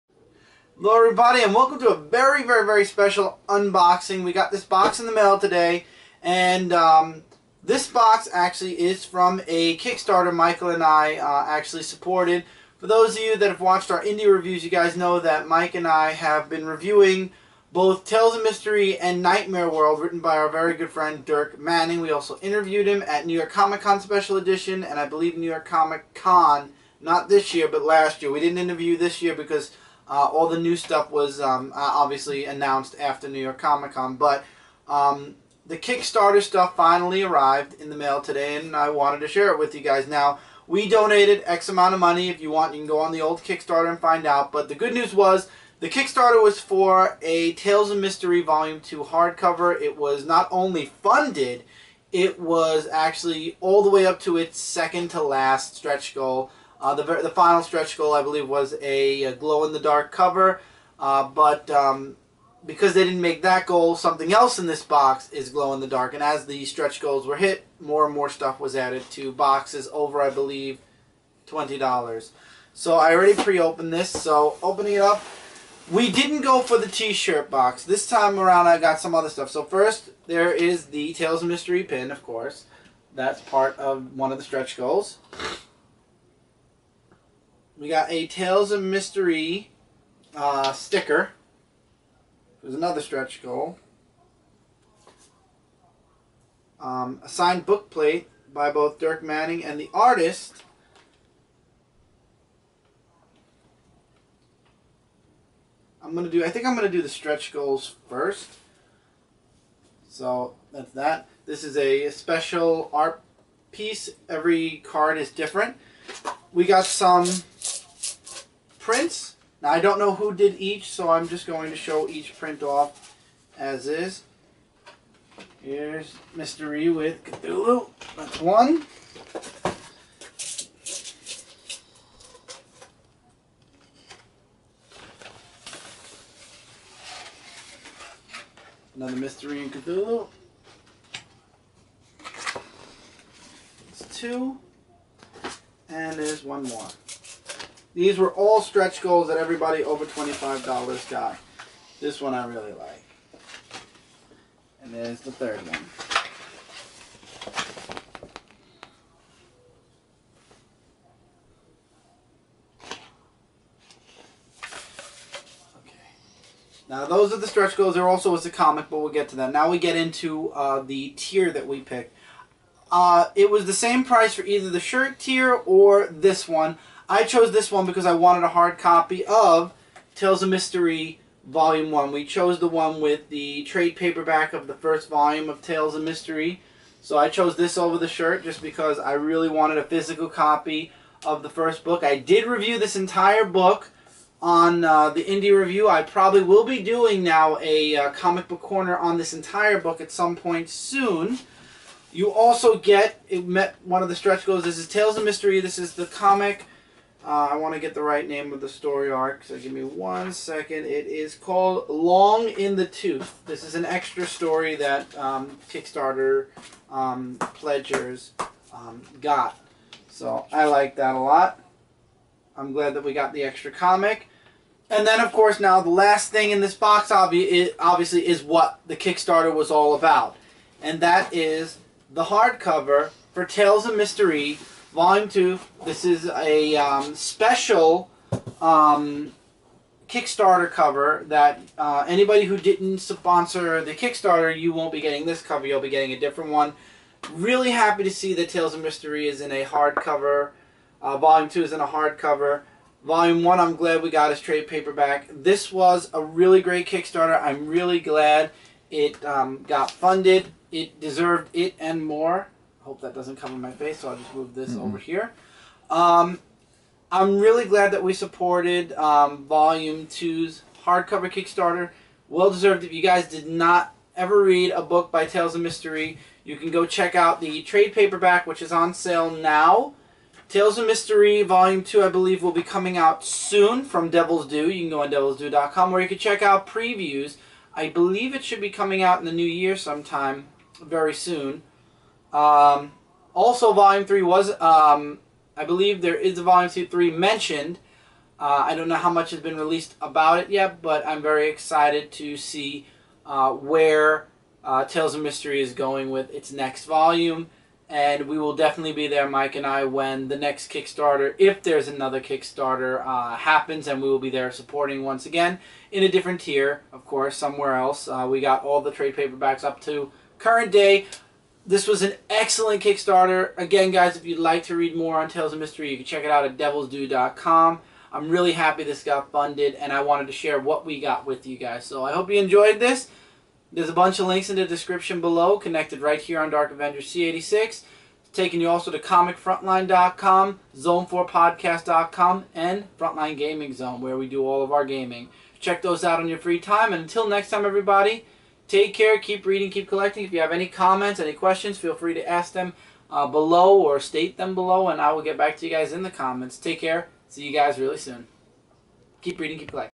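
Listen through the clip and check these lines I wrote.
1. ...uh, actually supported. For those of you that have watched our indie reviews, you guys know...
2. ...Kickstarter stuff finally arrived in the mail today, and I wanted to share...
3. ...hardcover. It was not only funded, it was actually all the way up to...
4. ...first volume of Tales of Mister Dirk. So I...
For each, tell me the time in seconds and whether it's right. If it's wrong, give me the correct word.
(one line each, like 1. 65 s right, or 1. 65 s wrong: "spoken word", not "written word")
1. 11 s right
2. 35 s right
3. 49 s right
4. 184 s wrong: "Rhee", not "Dirk".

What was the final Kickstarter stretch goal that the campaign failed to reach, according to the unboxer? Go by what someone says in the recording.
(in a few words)
Glow in the dark cover.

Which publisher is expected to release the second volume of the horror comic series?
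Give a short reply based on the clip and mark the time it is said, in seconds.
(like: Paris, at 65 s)
Devil's Due, at 284 s.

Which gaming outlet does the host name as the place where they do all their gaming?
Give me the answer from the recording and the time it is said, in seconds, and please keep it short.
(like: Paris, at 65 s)
Frontline Gaming Zone, at 342 s.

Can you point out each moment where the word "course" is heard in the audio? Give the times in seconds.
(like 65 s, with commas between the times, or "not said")
82 s, 225 s, 317 s.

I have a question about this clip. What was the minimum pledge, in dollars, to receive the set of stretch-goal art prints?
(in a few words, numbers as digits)
$25.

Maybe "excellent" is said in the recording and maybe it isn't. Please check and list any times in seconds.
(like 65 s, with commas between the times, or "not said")
322 s.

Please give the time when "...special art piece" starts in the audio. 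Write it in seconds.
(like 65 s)
112 s.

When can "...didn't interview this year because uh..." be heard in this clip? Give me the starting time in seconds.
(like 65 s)
28 s.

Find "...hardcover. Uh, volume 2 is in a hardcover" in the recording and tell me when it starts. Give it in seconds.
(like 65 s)
249 s.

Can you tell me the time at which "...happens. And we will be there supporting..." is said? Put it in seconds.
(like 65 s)
313 s.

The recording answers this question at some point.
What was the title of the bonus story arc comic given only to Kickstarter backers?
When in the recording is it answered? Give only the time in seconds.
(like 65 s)
211 s.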